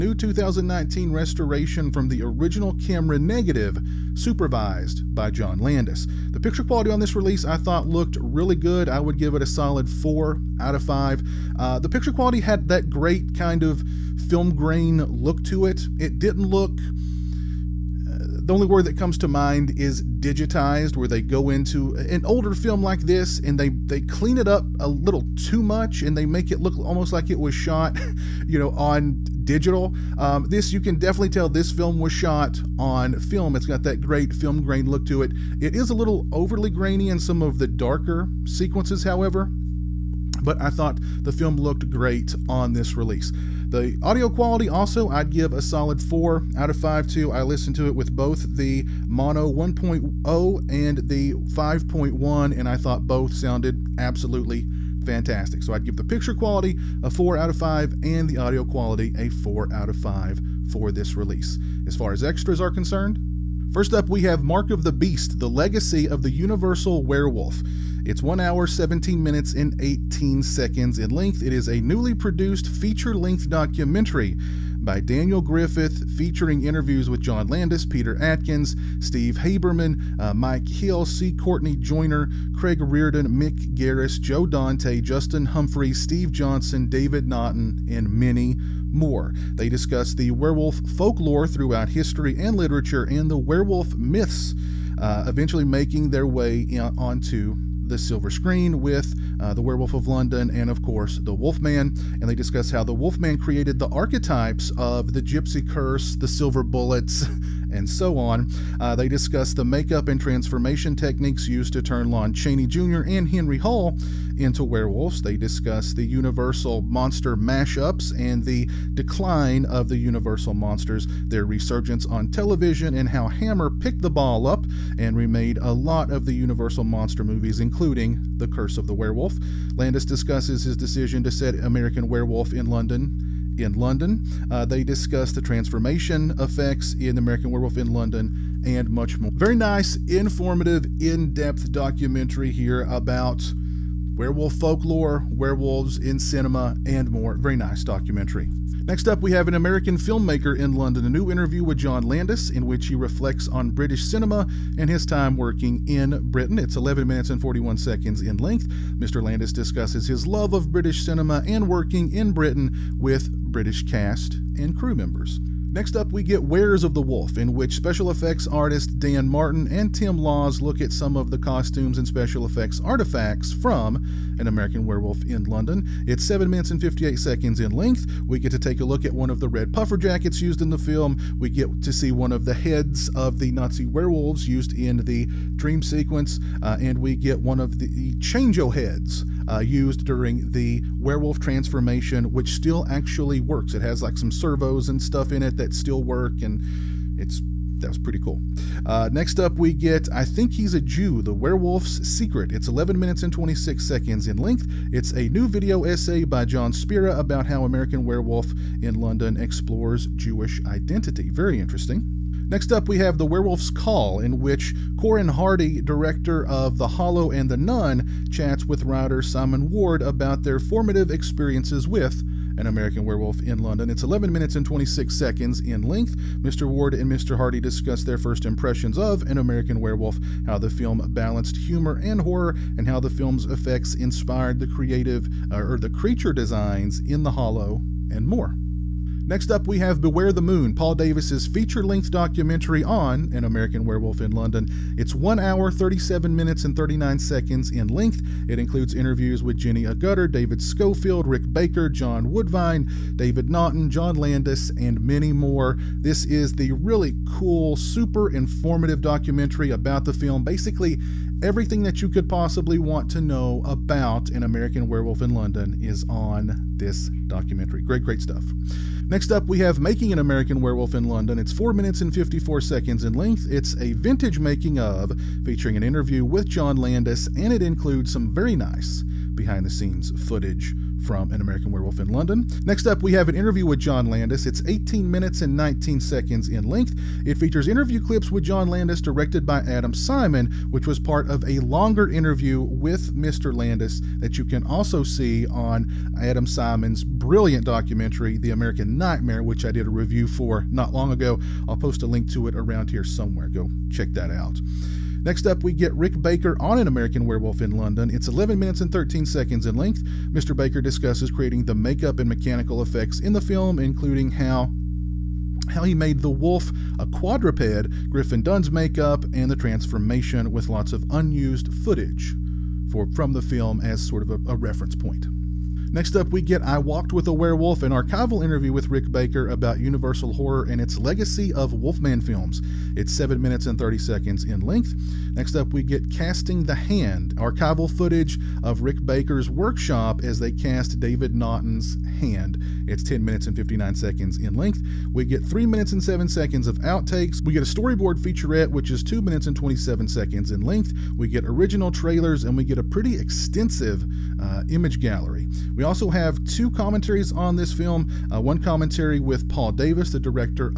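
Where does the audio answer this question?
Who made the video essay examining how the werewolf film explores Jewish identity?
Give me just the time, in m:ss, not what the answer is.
3:26.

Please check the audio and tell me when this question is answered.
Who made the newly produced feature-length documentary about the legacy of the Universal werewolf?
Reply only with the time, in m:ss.
1:15.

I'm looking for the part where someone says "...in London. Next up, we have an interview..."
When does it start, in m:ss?
4:41.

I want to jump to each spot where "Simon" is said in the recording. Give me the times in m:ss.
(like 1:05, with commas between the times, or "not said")
3:39, 4:49, 4:56.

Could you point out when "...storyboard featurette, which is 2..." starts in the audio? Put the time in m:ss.
5:47.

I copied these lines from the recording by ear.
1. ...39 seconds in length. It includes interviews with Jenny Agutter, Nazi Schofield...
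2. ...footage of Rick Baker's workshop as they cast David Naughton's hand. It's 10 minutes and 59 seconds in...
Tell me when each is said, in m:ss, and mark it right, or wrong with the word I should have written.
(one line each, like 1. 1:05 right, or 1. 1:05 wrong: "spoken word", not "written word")
1. 4:06 wrong: "David", not "Nazi"
2. 5:37 right.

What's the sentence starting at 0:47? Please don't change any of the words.
I listened to it with both the mono 1.0 and the 5.1, and I thought both sounded absolutely fantastic.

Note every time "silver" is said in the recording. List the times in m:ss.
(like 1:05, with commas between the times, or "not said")
1:37, 1:46.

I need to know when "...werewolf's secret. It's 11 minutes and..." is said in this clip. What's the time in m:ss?
3:21.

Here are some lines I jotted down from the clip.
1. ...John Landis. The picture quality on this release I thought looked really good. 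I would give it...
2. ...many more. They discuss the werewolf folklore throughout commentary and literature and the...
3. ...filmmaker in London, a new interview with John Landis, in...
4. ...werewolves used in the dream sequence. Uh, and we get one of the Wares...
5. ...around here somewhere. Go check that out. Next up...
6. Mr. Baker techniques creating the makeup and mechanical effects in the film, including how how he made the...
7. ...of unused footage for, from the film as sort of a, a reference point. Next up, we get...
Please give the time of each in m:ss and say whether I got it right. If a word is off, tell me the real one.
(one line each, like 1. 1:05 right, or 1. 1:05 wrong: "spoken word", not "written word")
1. 0:05 right
2. 1:28 wrong: "history", not "commentary"
3. 2:29 right
4. 3:03 wrong: "Changeo", not "Wares"
5. 5:02 right
6. 5:10 wrong: "discusses", not "techniques"
7. 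5:20 right.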